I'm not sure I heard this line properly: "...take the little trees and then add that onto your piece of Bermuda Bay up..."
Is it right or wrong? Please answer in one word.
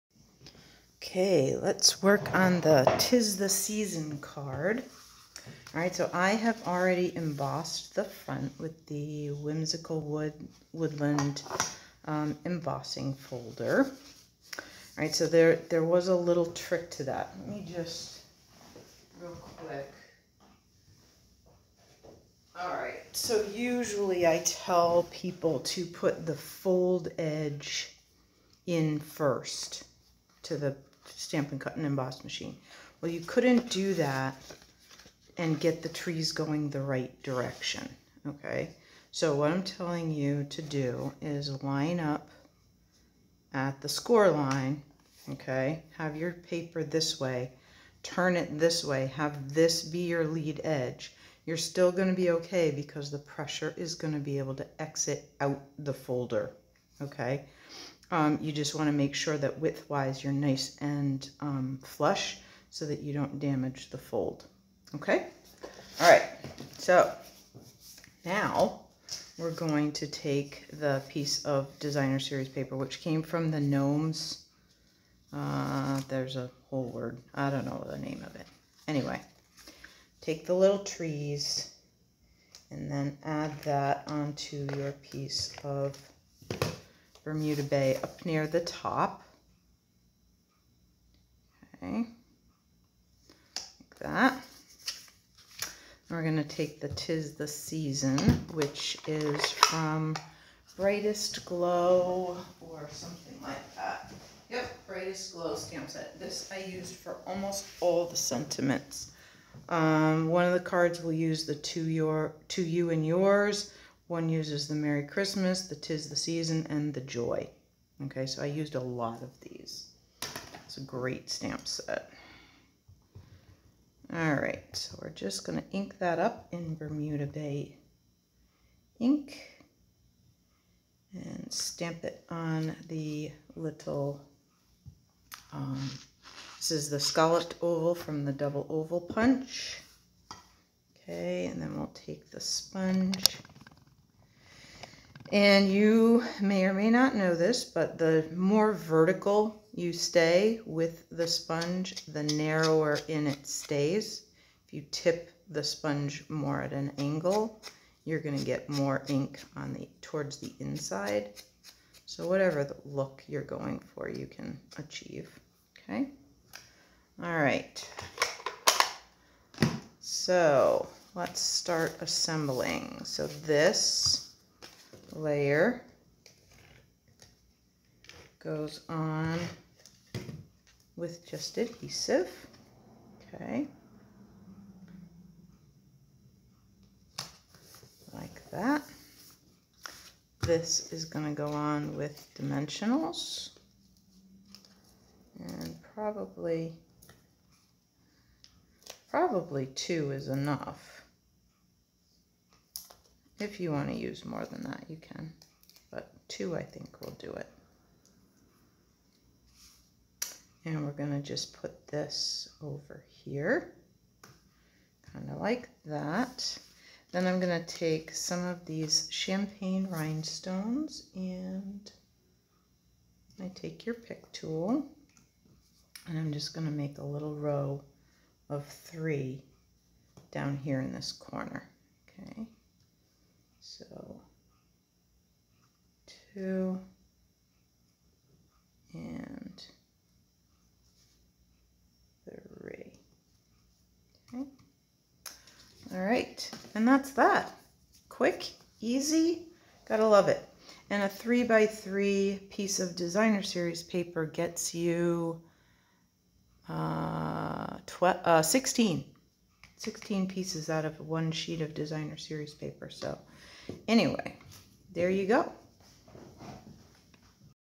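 right.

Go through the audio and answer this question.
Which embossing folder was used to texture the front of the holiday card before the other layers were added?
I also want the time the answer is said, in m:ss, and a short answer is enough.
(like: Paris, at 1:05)
Whimsical Wood Woodland, at 0:09.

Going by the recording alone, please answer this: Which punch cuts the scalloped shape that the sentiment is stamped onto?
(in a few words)
double oval punch.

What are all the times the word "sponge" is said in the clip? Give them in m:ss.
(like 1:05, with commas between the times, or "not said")
2:22, 2:31, 2:35.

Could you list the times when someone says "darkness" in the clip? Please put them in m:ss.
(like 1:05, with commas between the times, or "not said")
not said.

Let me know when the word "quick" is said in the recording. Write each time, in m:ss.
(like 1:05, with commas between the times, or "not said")
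0:19, 4:08.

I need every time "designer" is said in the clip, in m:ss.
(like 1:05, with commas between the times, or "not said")
1:11, 4:12, 4:21.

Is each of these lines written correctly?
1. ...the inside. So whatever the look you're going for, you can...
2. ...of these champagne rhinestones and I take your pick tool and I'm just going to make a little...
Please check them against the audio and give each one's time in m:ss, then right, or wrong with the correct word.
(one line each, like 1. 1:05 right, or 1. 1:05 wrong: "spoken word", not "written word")
1. 2:40 right
2. 3:38 right.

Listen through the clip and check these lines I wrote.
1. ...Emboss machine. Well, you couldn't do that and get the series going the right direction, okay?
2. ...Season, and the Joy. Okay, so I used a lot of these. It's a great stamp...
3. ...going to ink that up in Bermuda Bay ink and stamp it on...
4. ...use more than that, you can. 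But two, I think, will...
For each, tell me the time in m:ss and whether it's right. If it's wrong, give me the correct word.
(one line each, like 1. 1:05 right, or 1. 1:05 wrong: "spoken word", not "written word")
1. 0:31 wrong: "trees", not "series"
2. 1:56 right
3. 2:05 right
4. 3:23 right.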